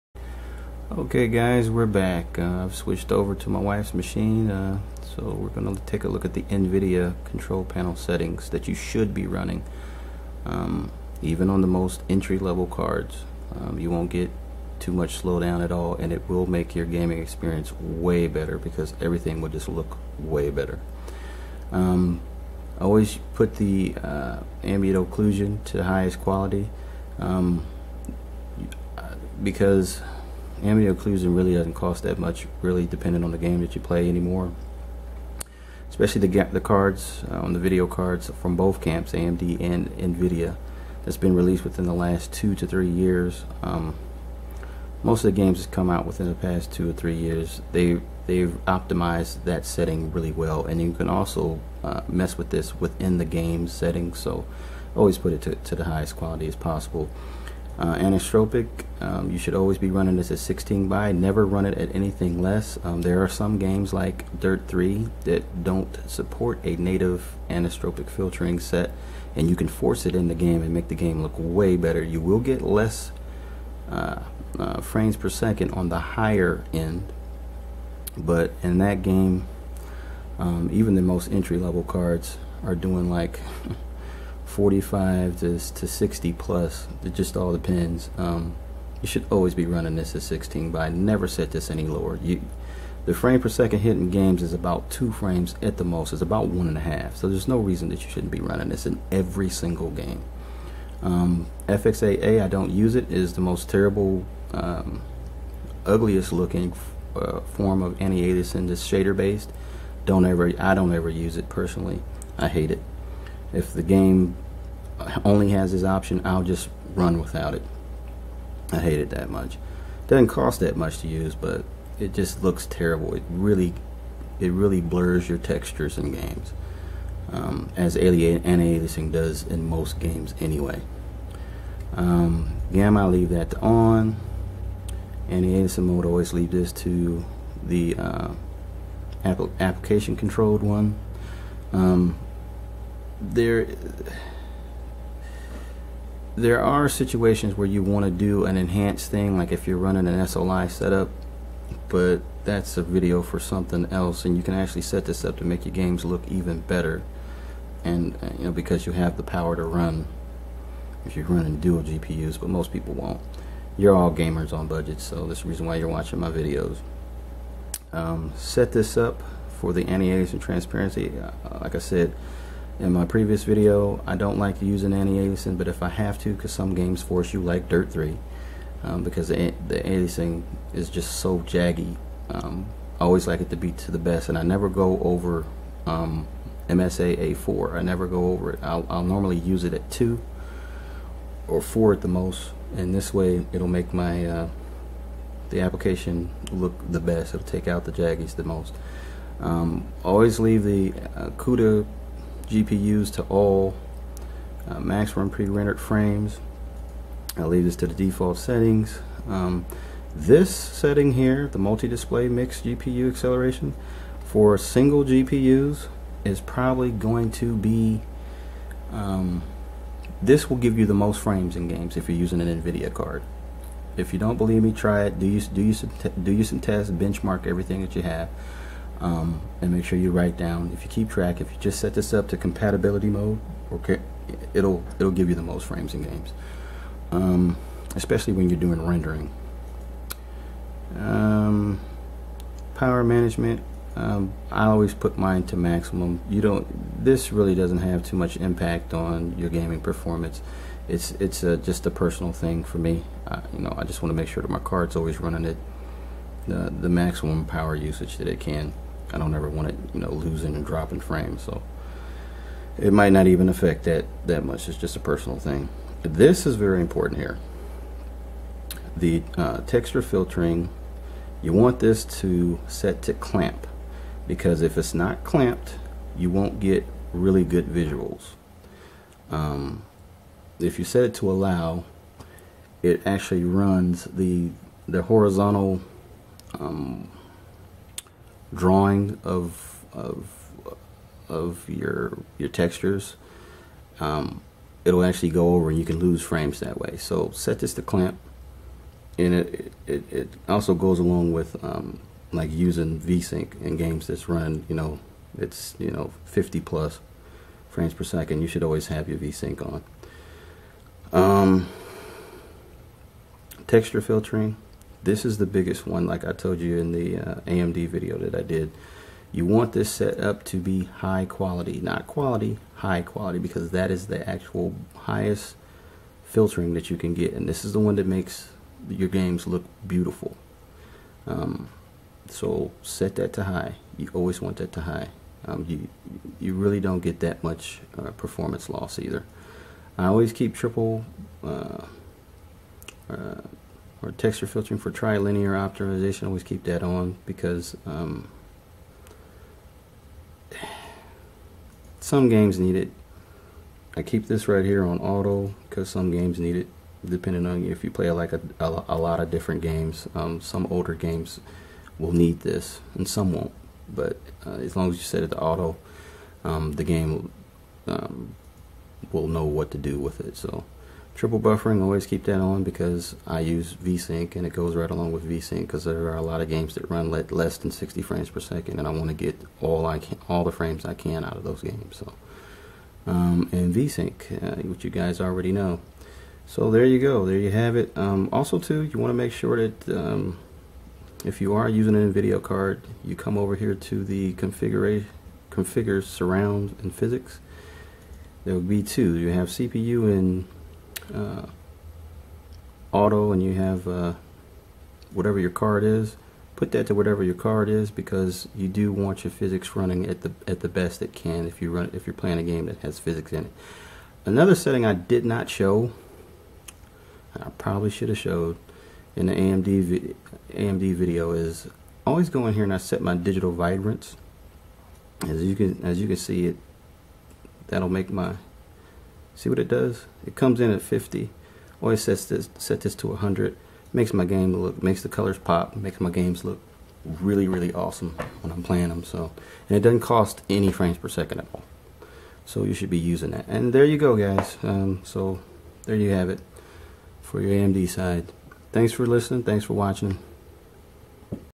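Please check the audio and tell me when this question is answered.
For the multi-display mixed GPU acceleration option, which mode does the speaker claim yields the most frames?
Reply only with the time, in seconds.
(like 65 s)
232 s.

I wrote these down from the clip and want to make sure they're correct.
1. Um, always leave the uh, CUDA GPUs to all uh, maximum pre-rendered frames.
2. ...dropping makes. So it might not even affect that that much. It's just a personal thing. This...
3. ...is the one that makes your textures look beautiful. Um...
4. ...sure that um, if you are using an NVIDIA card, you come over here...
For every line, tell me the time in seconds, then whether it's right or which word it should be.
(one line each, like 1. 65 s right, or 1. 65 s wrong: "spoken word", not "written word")
1. 199 s right
2. 260 s wrong: "frames", not "makes"
3. 327 s wrong: "games", not "textures"
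4. 389 s right.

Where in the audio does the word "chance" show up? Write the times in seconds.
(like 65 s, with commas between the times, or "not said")
not said.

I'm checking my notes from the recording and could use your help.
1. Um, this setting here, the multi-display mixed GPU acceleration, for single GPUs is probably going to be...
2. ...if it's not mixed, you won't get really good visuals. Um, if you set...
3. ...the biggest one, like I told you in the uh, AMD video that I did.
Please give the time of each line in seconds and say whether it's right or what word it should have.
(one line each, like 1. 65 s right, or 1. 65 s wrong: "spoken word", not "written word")
1. 209 s right
2. 274 s wrong: "clamped", not "mixed"
3. 315 s right.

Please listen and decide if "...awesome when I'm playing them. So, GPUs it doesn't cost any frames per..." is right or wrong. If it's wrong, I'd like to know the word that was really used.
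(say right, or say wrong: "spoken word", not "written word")
wrong: "And", not "GPUs".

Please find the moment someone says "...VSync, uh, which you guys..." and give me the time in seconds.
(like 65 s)
383 s.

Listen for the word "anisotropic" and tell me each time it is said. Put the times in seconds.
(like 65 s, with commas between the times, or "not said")
57 s, 67 s.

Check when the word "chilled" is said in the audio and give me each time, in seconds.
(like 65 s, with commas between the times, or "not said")
not said.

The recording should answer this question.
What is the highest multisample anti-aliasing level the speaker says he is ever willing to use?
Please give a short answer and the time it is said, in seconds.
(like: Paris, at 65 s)
MSAA 4, at 186 s.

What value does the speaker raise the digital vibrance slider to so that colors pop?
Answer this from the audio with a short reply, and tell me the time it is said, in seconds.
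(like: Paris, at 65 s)
100, at 433 s.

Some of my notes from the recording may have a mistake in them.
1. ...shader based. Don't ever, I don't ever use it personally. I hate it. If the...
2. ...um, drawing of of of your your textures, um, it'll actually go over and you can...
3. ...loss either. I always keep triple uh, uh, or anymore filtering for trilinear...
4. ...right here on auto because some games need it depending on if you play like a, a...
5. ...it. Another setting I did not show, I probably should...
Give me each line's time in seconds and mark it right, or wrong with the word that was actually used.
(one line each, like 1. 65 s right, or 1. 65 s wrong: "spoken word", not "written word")
1. 108 s right
2. 286 s right
3. 338 s wrong: "texture", not "anymore"
4. 354 s right
5. 413 s right.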